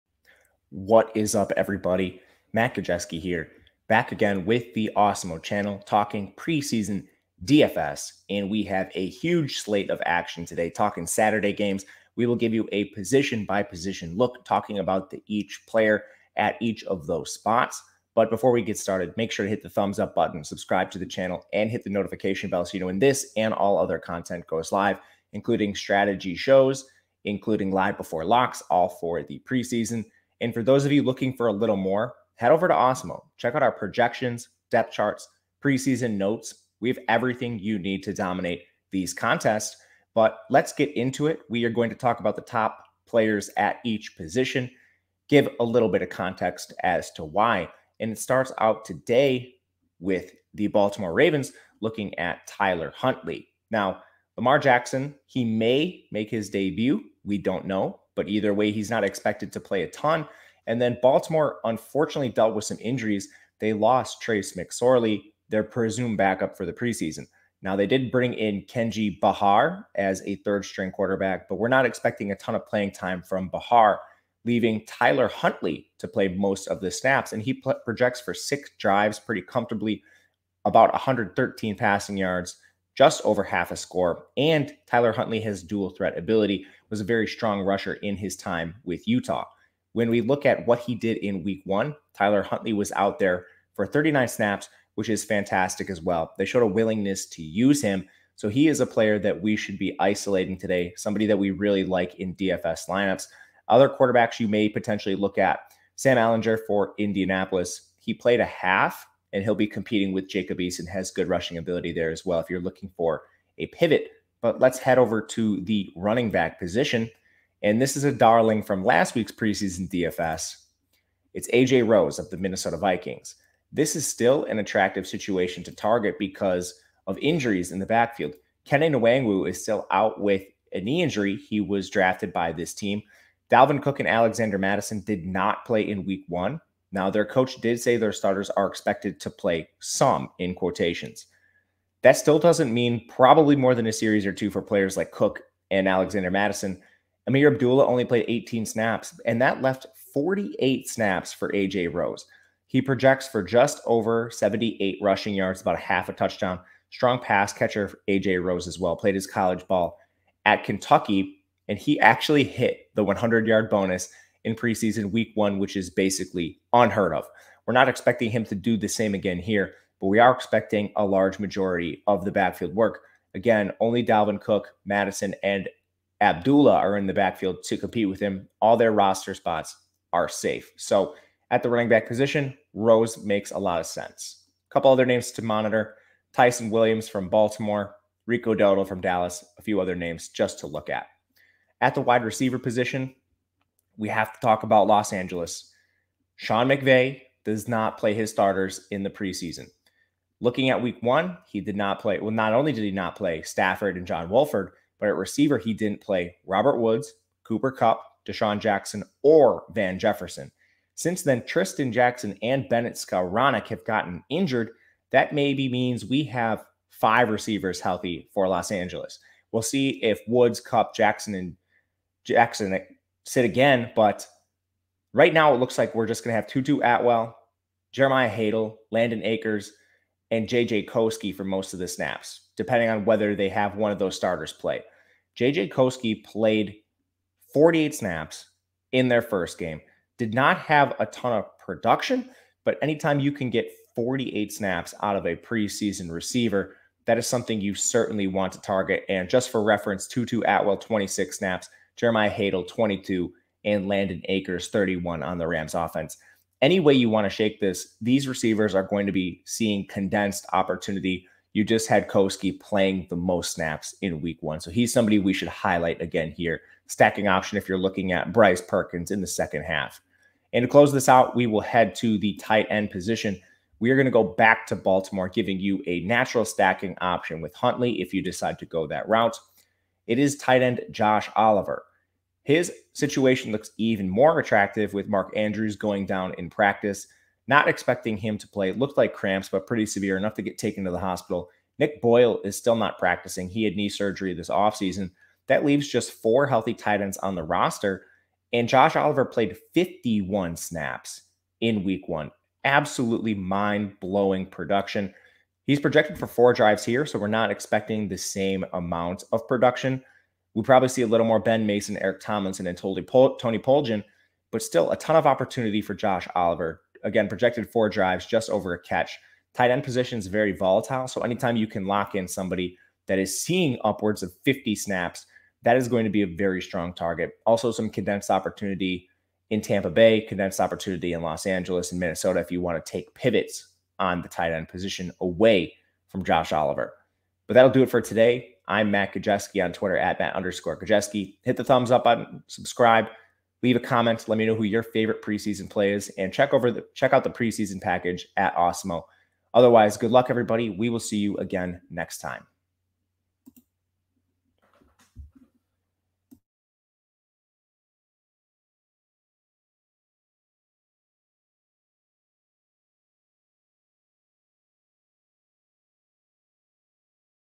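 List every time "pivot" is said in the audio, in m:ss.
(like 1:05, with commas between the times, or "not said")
1:53, 5:33.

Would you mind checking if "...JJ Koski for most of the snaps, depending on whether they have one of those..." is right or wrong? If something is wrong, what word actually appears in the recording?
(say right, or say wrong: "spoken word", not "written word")
right.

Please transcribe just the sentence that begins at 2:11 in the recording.
He was drafted by this team.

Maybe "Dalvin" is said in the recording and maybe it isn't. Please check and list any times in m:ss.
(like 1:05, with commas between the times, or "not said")
2:13, 2:54.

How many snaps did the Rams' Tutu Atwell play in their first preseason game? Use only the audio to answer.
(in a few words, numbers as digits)
26.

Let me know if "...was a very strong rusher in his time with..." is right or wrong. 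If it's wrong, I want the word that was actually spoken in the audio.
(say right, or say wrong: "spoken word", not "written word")
right.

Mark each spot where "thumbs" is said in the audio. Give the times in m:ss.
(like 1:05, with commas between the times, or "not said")
0:19, 5:41.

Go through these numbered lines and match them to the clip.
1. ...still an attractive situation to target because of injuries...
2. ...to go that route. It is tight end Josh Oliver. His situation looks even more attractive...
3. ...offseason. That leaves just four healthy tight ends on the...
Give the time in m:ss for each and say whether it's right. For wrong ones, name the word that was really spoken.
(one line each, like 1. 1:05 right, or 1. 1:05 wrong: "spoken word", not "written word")
1. 2:04 right
2. 4:38 right
3. 4:54 right.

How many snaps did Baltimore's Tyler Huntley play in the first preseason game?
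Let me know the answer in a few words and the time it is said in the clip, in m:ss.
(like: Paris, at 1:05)
39, at 1:33.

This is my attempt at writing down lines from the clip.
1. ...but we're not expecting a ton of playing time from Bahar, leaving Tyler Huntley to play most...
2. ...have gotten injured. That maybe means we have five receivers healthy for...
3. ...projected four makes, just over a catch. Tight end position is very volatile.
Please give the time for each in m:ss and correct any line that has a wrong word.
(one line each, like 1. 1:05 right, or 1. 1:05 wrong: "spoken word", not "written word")
1. 1:11 right
2. 3:33 right
3. 5:17 wrong: "drives", not "makes".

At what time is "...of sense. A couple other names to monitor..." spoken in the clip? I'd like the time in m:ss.
3:03.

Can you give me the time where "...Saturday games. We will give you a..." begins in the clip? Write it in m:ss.
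0:11.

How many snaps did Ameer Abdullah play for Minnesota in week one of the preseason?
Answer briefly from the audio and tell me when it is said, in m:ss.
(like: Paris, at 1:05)
18, at 2:28.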